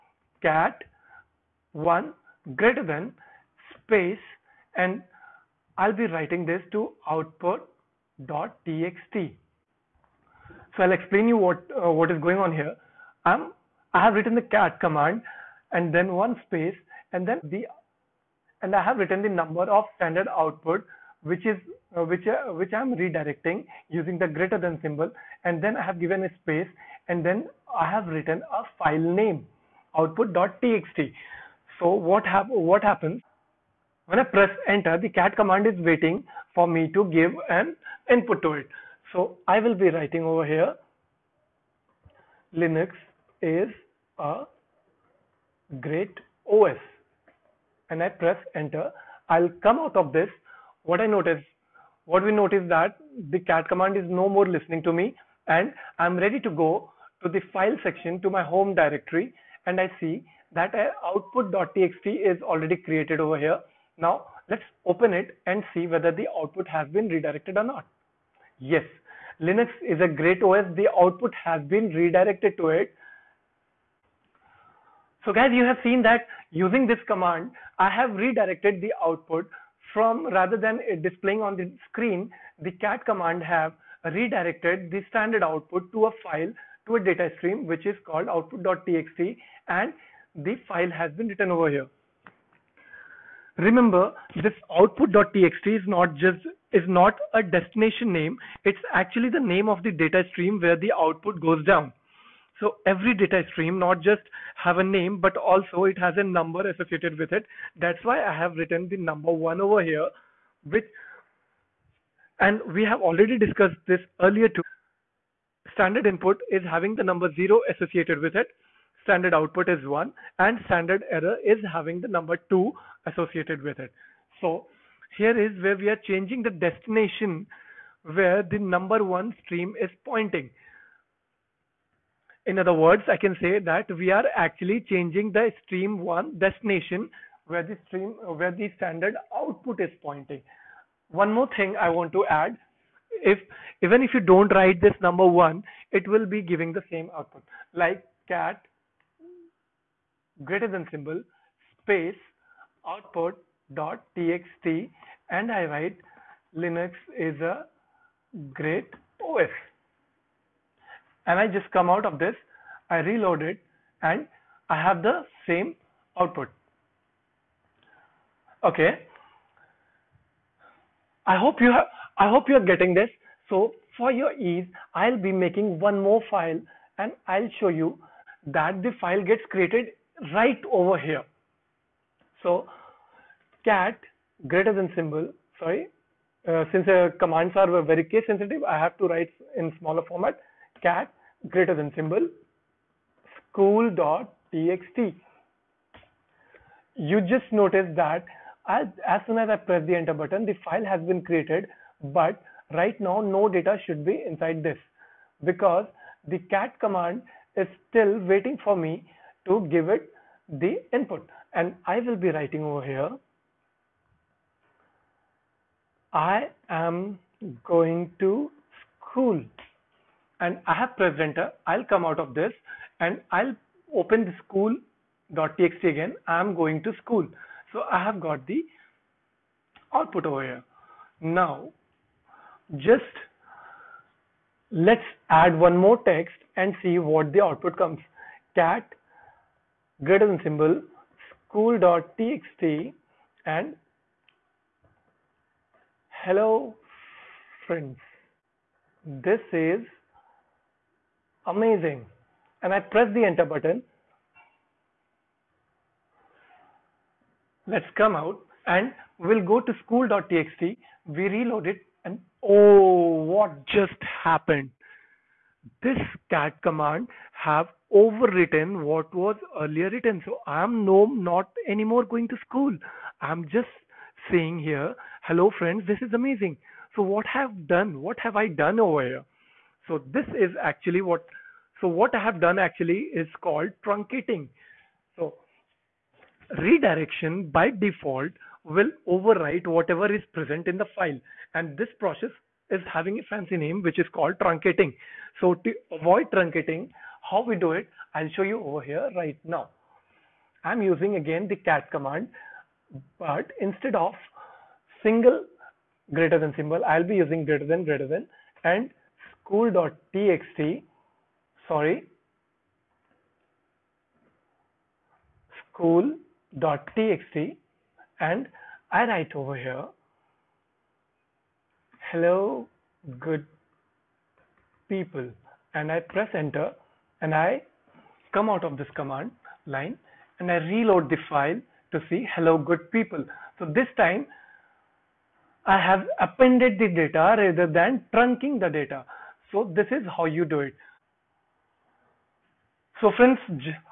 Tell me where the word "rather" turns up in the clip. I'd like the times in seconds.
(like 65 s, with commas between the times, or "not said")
80 s, 337 s.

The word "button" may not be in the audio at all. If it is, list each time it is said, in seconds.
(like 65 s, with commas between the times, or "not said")
200 s, 253 s.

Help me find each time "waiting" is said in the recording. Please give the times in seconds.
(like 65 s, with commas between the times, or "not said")
35 s, 208 s.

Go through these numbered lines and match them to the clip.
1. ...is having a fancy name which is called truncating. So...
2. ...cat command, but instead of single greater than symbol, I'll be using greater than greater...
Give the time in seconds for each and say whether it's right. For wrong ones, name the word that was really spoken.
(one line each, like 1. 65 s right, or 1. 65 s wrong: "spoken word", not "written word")
1. 292 s right
2. 301 s right.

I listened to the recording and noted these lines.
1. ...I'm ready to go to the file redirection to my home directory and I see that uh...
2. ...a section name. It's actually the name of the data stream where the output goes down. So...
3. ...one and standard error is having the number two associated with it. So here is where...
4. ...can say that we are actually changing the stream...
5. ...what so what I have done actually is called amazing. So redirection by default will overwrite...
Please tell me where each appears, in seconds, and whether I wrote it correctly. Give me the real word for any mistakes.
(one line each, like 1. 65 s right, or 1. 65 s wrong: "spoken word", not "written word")
1. 55 s wrong: "section", not "redirection"
2. 97 s wrong: "destination", not "section"
3. 119 s right
4. 133 s right
5. 281 s wrong: "truncating", not "amazing".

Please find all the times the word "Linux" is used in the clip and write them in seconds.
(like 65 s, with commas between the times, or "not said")
42 s, 69 s, 156 s.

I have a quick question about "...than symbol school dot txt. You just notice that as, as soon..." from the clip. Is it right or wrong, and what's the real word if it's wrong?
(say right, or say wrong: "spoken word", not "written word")
right.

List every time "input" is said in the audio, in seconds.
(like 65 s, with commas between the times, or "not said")
38 s, 116 s, 210 s.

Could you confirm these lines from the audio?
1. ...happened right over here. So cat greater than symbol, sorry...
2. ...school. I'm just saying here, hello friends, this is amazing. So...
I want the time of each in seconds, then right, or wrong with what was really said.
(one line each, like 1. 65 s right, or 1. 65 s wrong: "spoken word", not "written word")
1. 179 s wrong: "created", not "happened"
2. 272 s right.